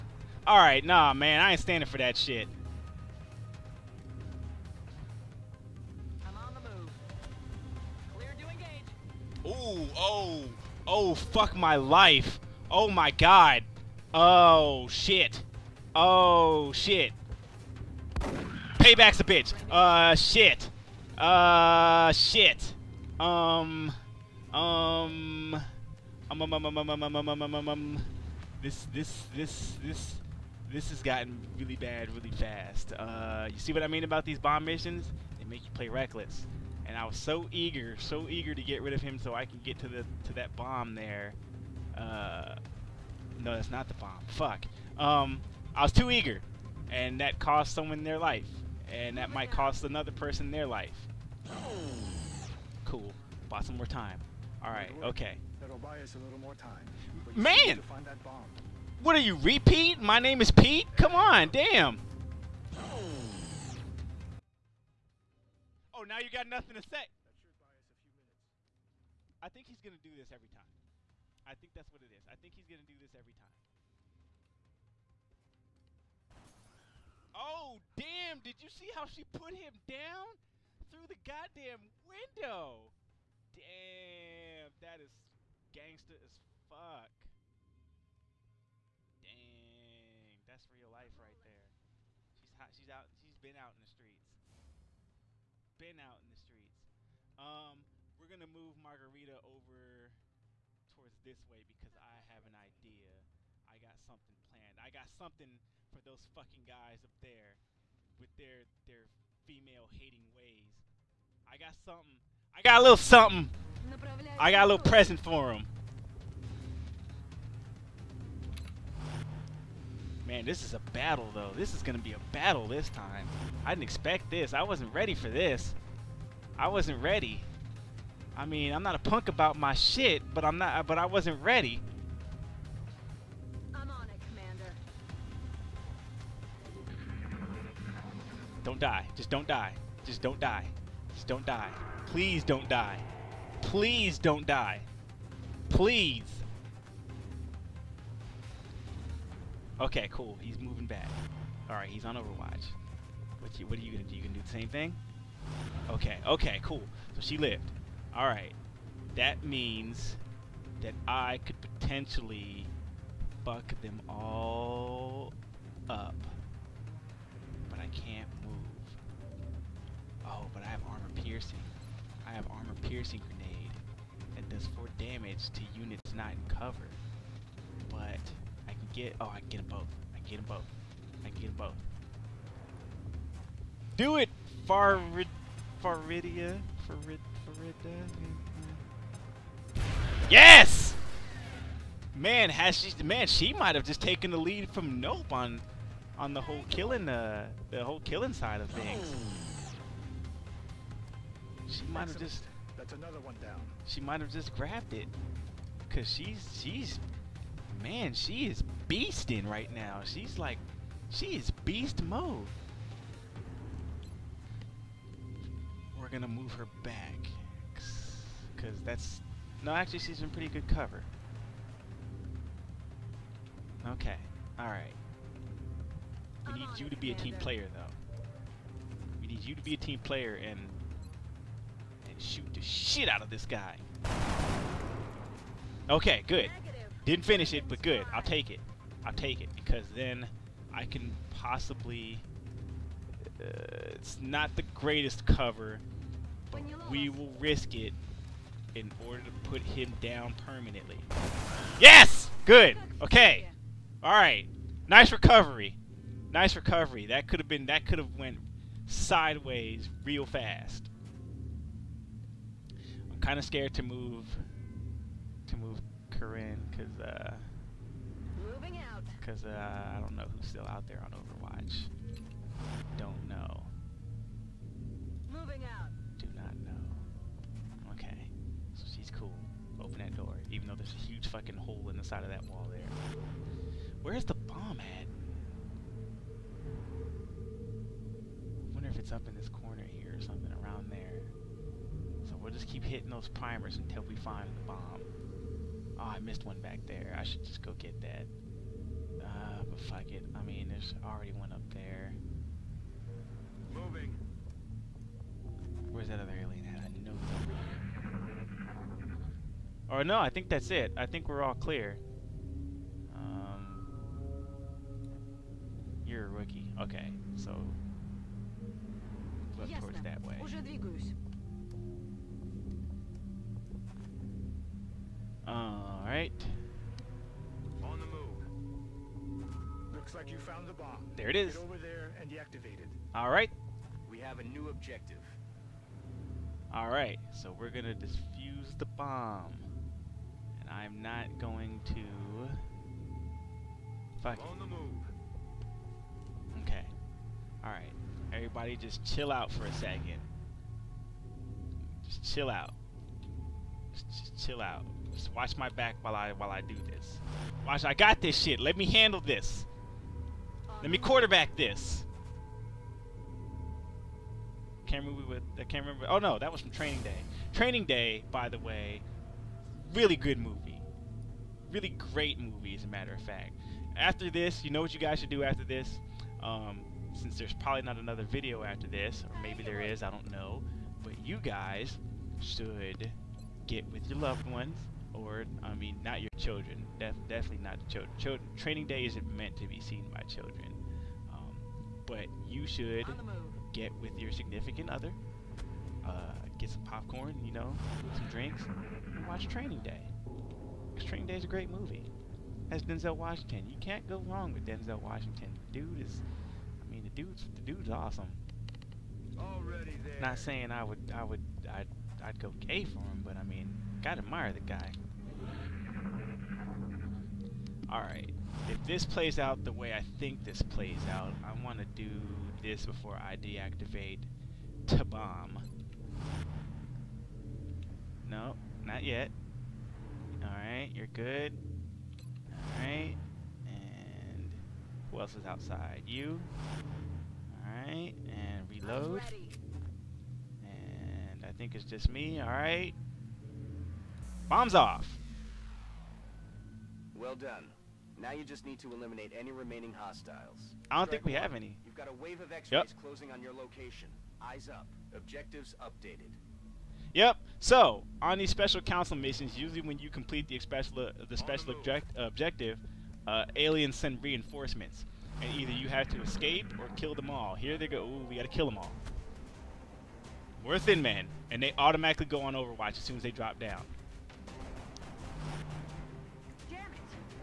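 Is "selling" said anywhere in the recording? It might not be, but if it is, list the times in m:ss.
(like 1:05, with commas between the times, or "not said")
not said.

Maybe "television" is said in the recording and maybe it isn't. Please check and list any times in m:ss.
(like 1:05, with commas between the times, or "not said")
not said.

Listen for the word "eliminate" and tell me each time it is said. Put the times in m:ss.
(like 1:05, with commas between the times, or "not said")
7:28.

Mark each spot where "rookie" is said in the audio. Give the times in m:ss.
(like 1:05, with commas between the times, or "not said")
5:16.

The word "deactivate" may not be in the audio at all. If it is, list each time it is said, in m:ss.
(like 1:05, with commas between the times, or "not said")
5:32, 7:03.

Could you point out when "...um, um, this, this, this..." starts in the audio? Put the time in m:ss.
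0:27.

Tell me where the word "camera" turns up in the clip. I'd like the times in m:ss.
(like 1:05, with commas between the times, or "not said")
not said.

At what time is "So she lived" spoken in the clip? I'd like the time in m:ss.
2:37.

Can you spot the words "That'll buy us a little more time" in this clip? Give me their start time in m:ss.
0:55.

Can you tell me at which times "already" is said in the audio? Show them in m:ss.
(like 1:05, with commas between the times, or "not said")
5:01, 6:49.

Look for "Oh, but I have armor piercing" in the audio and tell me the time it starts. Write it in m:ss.
2:50.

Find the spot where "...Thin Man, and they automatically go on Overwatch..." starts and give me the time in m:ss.
7:50.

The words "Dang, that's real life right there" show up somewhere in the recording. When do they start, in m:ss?
1:29.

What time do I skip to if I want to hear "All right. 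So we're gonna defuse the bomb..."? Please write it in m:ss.
5:36.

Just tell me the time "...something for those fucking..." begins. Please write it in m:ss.
1:45.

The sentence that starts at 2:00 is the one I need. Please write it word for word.
Man, this is a battle, though.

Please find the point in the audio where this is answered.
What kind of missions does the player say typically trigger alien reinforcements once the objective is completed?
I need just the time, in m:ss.
7:38.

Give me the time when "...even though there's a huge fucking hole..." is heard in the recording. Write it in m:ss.
4:40.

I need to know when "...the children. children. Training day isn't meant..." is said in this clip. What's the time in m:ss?
6:27.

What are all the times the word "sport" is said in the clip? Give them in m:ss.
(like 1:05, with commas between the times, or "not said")
not said.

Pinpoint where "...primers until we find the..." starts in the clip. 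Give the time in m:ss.
4:53.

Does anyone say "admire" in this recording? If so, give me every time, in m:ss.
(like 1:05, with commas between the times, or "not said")
6:54.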